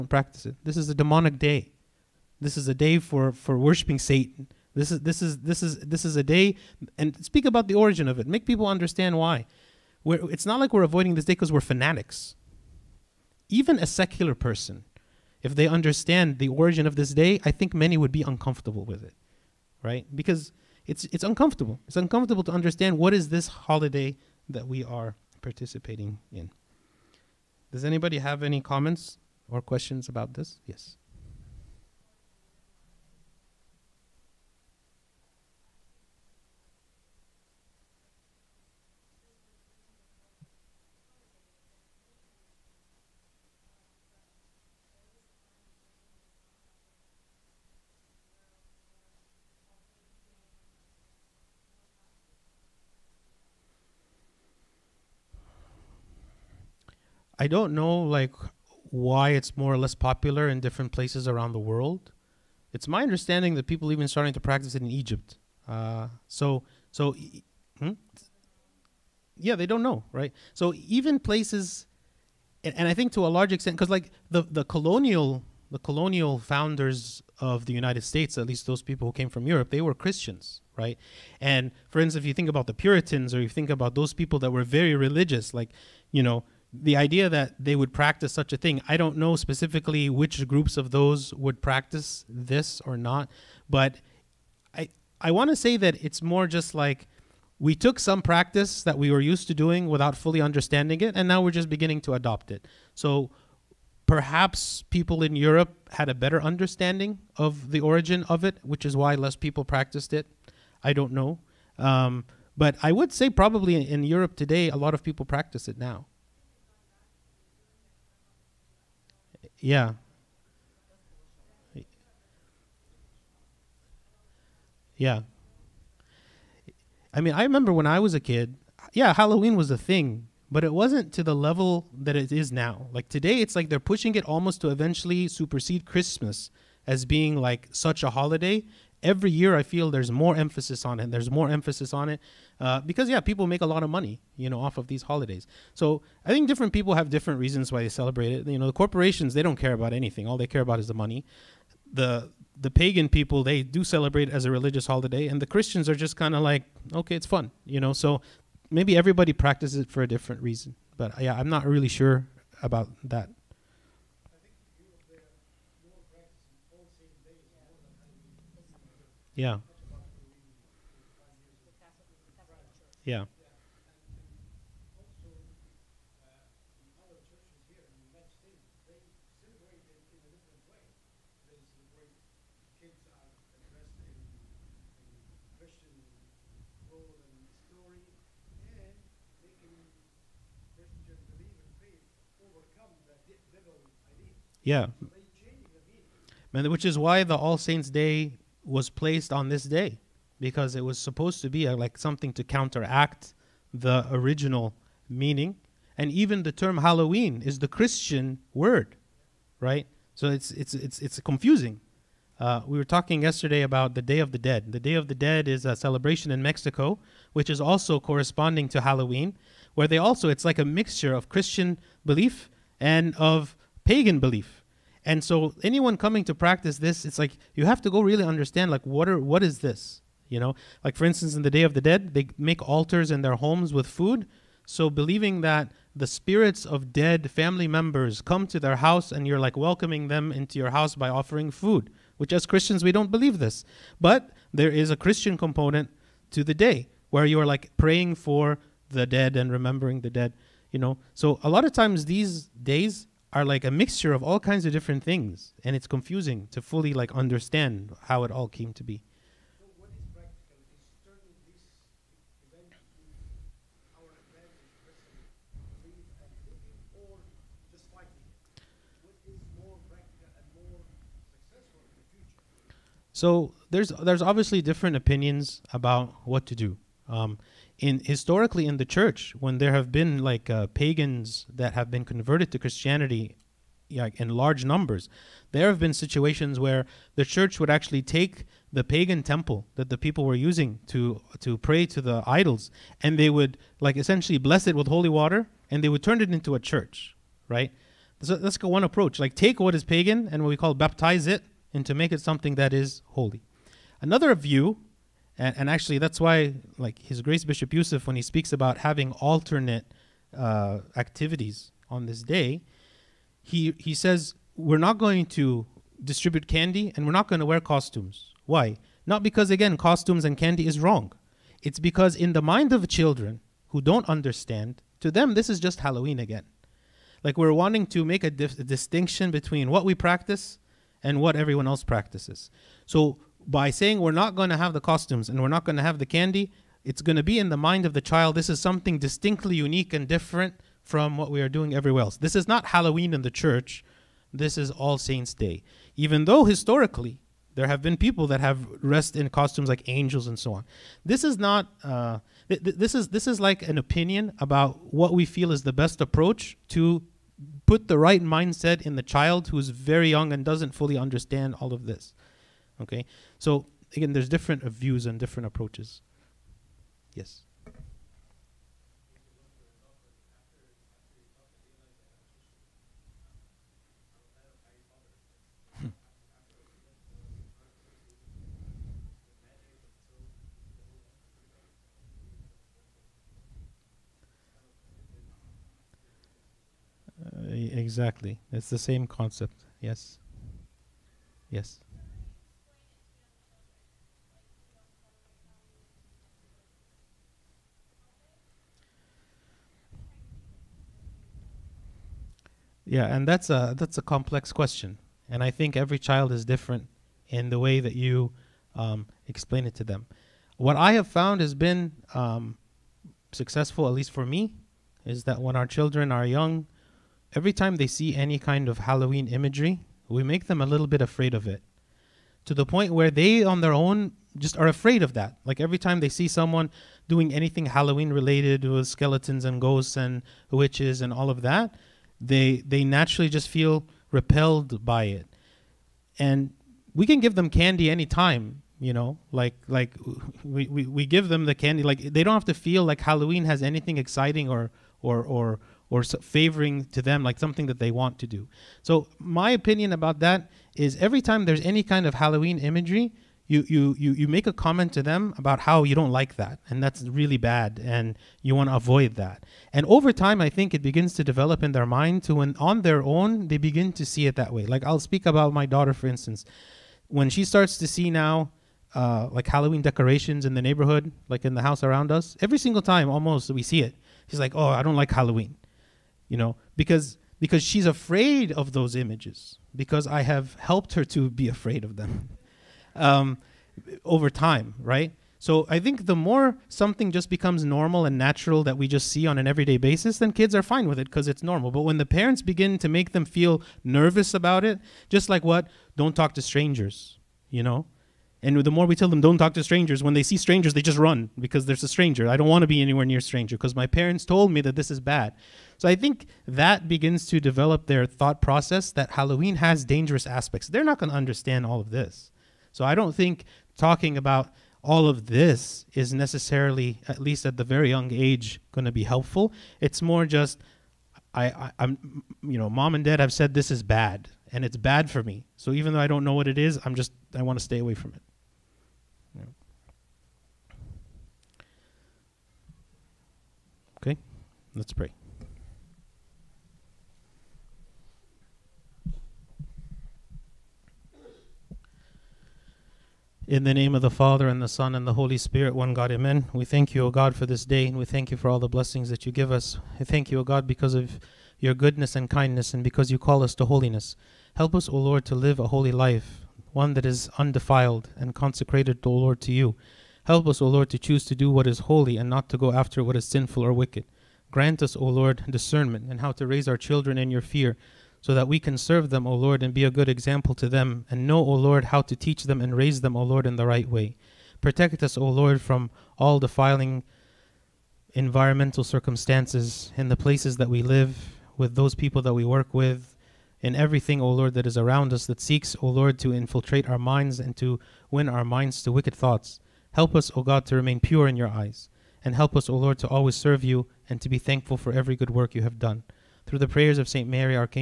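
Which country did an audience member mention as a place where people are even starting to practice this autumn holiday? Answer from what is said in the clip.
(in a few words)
Egypt.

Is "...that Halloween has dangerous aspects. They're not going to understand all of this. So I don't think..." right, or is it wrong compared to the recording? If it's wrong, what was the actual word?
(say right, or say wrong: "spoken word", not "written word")
right.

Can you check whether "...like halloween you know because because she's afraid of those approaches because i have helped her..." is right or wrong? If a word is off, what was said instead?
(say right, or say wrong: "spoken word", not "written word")
wrong: "images", not "approaches".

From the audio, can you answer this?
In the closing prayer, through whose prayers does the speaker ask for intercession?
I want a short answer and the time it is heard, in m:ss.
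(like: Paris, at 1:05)
St. Mary, at 9:57.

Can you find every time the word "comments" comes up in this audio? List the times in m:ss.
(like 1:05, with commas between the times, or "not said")
0:28, 7:34.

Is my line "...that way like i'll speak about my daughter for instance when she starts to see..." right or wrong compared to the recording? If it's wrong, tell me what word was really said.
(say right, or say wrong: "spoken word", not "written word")
right.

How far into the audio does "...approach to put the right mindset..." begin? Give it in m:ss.
5:56.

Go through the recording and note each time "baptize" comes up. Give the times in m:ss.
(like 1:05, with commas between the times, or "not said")
5:00.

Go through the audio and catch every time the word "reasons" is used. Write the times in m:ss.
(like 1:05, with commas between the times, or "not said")
2:27, 2:40.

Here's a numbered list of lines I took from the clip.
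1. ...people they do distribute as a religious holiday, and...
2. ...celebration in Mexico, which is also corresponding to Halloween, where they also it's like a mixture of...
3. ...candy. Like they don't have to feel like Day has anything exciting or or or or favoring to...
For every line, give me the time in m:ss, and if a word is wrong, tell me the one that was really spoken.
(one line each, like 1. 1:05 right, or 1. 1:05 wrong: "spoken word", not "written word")
1. 2:33 wrong: "celebrate", not "distribute"
2. 3:35 right
3. 7:21 wrong: "Halloween", not "Day".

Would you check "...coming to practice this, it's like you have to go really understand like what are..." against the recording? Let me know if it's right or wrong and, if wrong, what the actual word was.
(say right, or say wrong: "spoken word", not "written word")
right.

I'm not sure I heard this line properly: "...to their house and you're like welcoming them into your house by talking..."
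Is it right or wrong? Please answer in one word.
wrong.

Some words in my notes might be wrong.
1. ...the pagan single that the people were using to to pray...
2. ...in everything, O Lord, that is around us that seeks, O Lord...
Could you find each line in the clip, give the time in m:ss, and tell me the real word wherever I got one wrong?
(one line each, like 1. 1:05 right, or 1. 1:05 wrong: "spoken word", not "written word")
1. 4:48 wrong: "temple", not "single"
2. 9:43 right.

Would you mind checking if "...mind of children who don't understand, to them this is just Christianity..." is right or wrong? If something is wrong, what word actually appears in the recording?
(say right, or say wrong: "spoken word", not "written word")
wrong: "Halloween", not "Christianity".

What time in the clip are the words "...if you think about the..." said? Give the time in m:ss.
1:22.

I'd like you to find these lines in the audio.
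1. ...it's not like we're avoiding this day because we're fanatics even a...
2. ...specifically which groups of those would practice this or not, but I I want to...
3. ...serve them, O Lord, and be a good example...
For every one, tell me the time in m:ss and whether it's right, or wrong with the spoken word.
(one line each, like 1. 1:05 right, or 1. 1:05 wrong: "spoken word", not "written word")
1. 0:10 right
2. 1:29 right
3. 9:28 right.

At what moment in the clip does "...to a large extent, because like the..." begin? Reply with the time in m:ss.
1:13.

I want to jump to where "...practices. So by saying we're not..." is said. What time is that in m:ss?
5:31.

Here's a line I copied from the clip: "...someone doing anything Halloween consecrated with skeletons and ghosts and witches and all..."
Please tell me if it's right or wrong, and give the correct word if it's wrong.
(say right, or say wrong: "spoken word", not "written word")
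wrong: "related", not "consecrated".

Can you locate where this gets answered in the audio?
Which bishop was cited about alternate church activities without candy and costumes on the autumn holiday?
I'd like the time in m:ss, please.
5:07.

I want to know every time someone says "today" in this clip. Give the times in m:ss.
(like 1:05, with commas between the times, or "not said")
1:54, 2:13.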